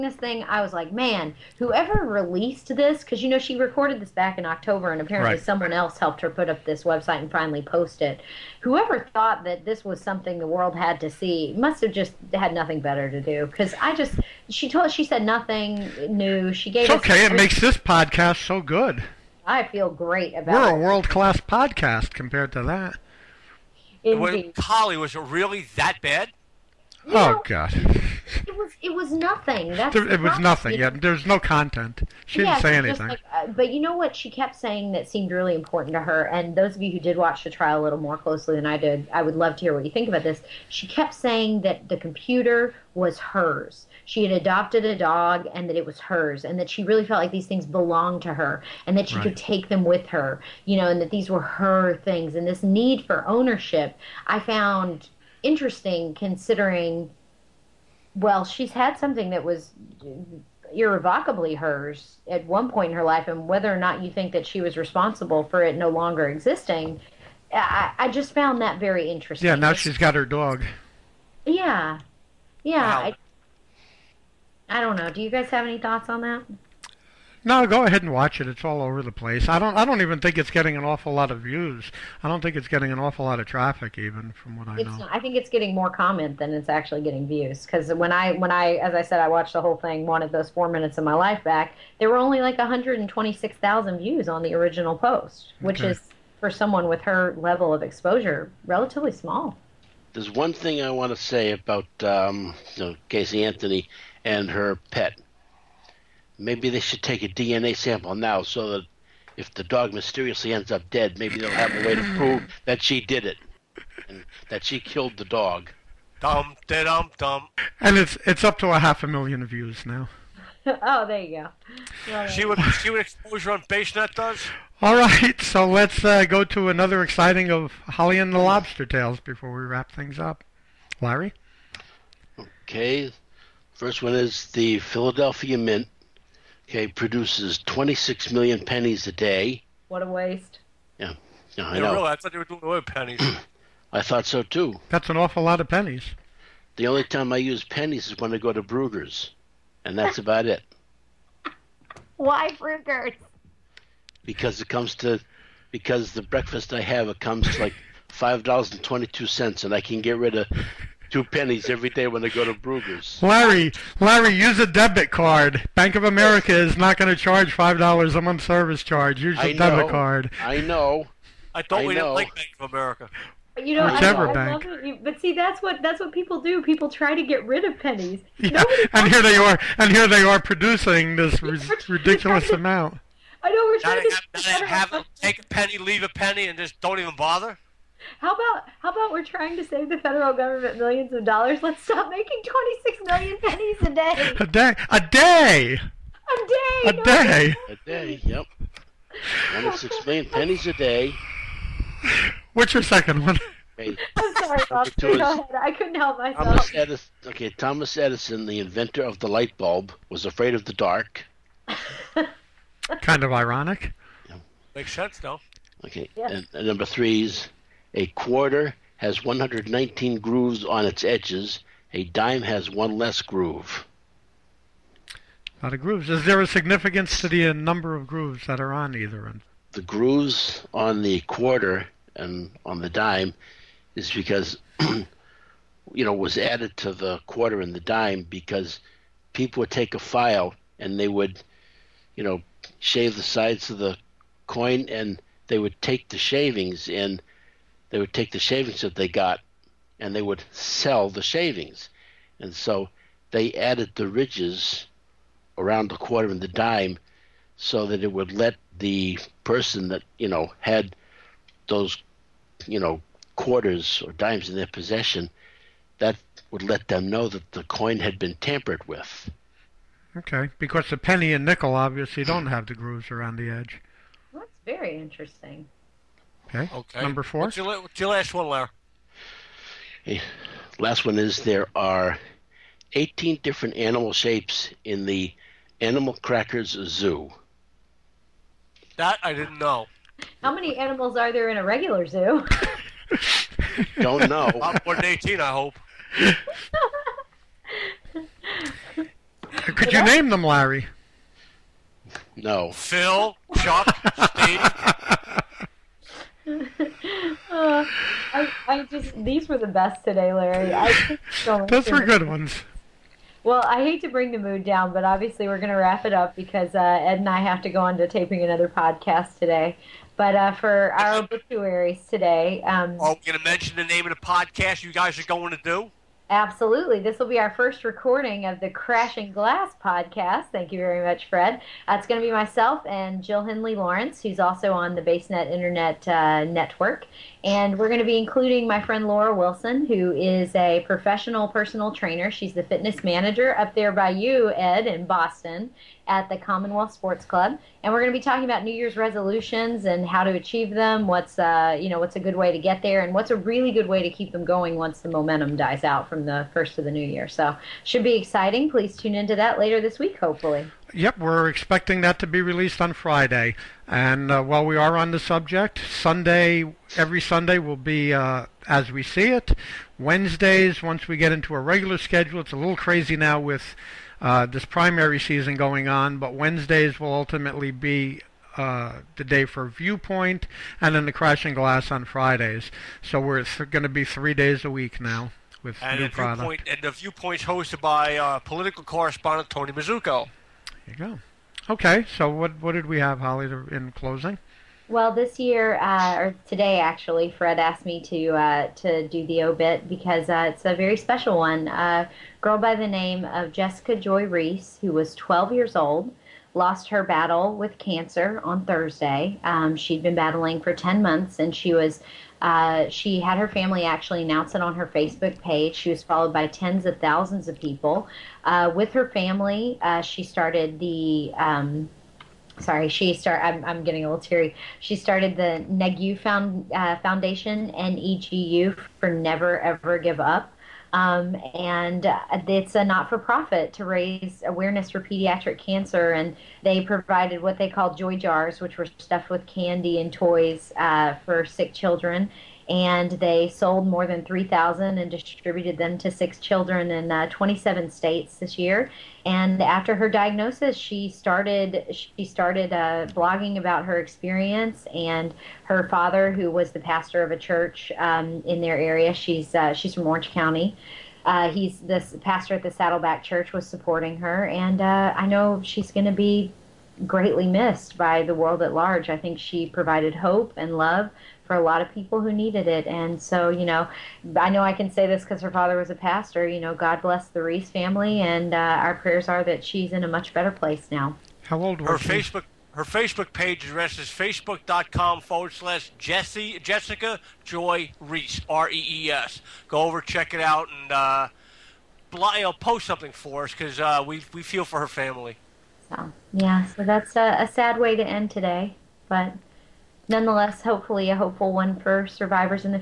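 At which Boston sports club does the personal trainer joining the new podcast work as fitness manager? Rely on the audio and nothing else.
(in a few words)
Commonwealth Sports Club.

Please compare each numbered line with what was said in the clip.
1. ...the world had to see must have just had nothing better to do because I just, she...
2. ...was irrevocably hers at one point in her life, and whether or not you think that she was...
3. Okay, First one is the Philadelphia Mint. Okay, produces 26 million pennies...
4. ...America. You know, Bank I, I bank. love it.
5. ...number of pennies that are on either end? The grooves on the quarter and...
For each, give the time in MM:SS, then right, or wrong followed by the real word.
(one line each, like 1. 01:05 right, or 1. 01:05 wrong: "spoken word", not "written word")
1. 00:10 right
2. 00:59 right
3. 02:12 right
4. 02:52 wrong: "Whichever", not "Bank"
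5. 03:47 wrong: "grooves", not "pennies".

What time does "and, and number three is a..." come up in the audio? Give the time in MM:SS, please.
03:36.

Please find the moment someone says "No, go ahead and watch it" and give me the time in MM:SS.
01:17.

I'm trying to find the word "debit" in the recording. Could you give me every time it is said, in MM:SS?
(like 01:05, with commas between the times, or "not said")
02:44, 02:49.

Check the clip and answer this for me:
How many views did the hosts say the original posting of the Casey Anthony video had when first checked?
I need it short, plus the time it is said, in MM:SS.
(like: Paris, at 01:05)
126,000, at 01:32.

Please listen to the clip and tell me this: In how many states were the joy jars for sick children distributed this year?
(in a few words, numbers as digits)
27.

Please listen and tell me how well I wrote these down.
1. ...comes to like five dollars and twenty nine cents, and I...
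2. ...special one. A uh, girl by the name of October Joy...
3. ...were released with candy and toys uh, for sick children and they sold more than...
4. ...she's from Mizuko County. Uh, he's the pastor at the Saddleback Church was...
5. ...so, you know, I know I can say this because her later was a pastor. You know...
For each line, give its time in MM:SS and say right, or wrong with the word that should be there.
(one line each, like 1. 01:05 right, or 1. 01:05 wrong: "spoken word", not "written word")
1. 02:37 wrong: "two", not "nine"
2. 06:40 wrong: "Jessica", not "October"
3. 07:18 wrong: "stuffed", not "released"
4. 07:39 wrong: "Orange", not "Mizuko"
5. 07:53 wrong: "father", not "later".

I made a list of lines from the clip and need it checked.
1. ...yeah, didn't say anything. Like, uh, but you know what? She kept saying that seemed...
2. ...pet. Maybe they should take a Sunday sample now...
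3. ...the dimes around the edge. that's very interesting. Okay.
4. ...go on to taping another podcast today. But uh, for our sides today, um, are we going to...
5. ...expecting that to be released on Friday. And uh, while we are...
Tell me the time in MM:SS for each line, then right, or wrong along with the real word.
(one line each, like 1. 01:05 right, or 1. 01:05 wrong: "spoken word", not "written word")
1. 00:32 right
2. 01:44 wrong: "DNA", not "Sunday"
3. 04:32 wrong: "grooves", not "dimes"
4. 05:17 wrong: "obituaries", not "sides"
5. 06:01 right.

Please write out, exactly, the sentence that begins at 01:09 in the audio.
Yeah, now she's got her dog.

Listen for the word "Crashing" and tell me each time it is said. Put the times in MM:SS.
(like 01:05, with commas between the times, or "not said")
05:28, 06:21.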